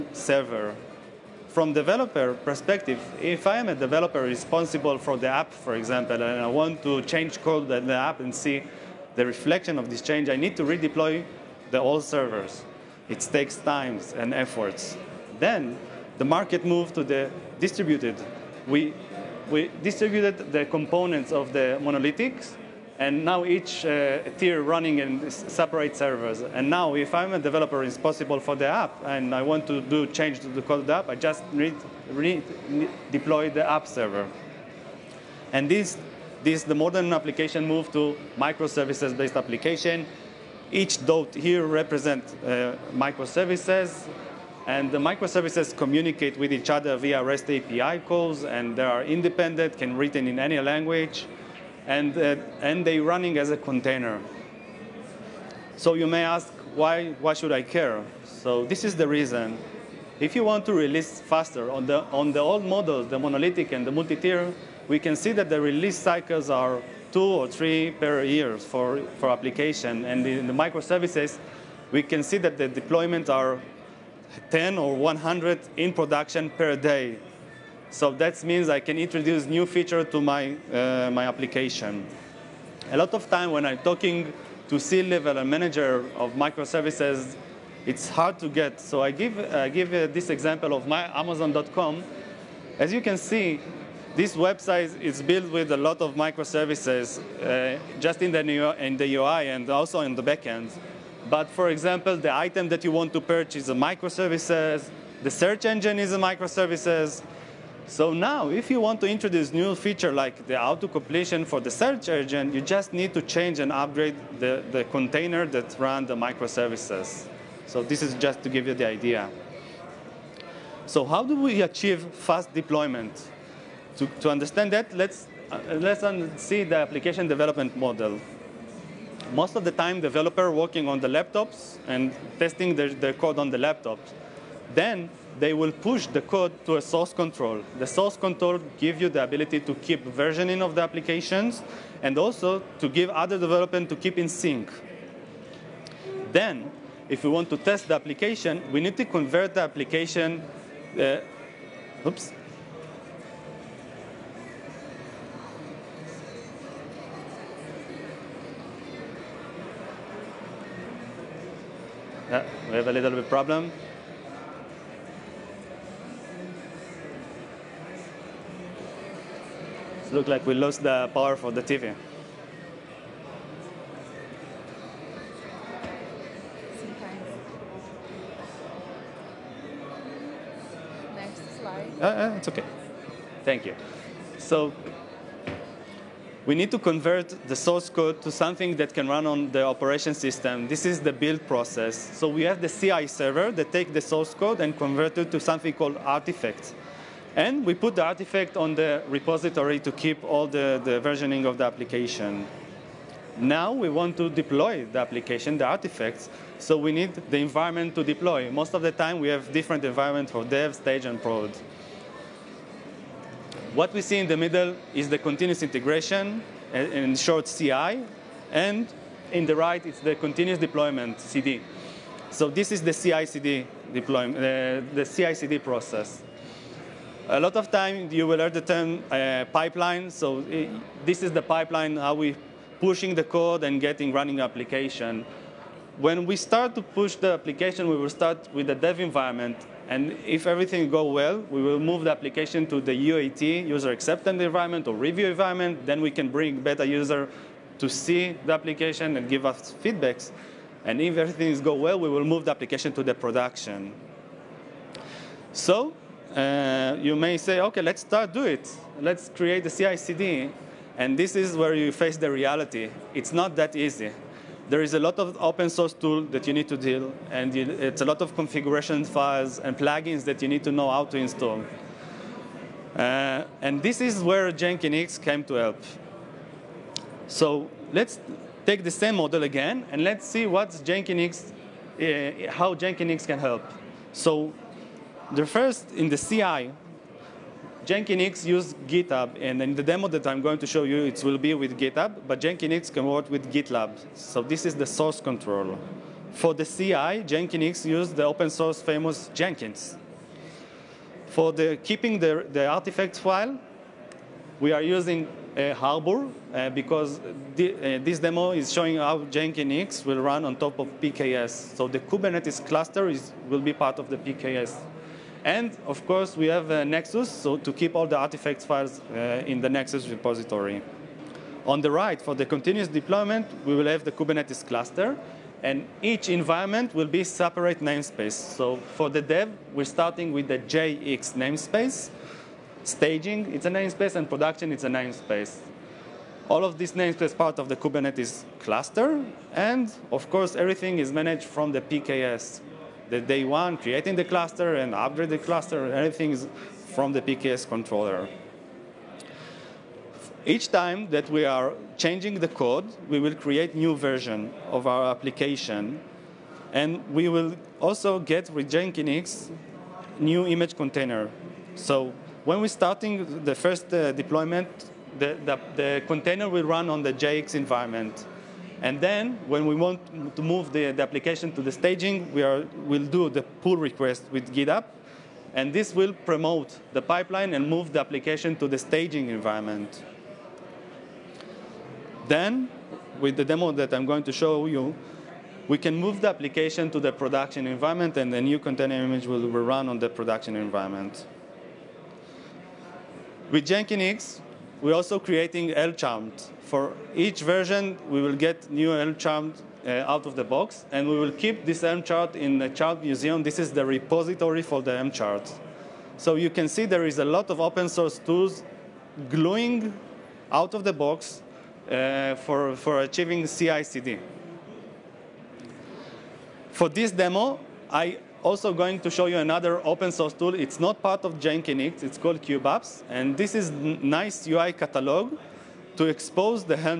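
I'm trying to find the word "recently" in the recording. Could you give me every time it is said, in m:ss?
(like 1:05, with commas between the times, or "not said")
not said.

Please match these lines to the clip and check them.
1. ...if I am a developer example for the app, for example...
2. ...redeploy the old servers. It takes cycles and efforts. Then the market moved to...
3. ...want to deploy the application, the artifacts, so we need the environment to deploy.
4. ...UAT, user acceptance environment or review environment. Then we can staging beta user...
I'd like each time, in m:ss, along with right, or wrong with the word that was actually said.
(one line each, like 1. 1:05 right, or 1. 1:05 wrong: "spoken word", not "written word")
1. 0:03 wrong: "responsible", not "example"
2. 0:10 wrong: "times", not "cycles"
3. 3:23 right
4. 4:03 wrong: "bring", not "staging".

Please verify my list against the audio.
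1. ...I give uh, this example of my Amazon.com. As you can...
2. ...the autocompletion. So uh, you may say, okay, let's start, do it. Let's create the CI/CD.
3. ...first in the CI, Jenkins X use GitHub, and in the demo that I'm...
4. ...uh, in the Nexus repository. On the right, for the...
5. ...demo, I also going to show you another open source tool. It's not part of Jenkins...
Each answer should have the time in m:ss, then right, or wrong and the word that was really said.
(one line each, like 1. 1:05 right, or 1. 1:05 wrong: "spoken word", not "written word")
1. 1:29 right
2. 4:13 wrong: "production", not "autocompletion"
3. 4:45 right
4. 5:19 right
5. 6:57 right.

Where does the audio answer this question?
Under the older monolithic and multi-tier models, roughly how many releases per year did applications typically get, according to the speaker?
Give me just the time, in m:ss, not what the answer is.
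1:07.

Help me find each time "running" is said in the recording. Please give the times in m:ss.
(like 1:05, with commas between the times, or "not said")
0:24, 0:52, 3:54.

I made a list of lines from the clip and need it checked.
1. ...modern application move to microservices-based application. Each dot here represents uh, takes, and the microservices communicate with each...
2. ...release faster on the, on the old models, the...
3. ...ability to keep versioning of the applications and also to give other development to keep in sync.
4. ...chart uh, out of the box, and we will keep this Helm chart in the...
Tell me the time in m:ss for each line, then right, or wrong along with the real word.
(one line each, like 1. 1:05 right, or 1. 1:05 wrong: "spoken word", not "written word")
1. 0:36 wrong: "microservices", not "takes"
2. 1:00 right
3. 2:19 right
4. 6:39 right.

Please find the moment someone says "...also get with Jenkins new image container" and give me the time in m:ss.
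5:57.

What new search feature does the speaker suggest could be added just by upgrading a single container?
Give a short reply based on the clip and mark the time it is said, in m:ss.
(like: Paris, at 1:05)
auto-completion, at 1:50.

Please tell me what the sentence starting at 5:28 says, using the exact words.
So for the dev, we're starting with the JX namespace.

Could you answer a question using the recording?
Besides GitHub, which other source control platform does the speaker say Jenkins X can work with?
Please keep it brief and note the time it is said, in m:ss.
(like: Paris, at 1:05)
GitLab, at 4:53.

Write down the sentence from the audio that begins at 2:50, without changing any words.
It looks like we lost the power for the TV.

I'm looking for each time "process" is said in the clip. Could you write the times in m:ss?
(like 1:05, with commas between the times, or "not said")
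3:11, 3:45.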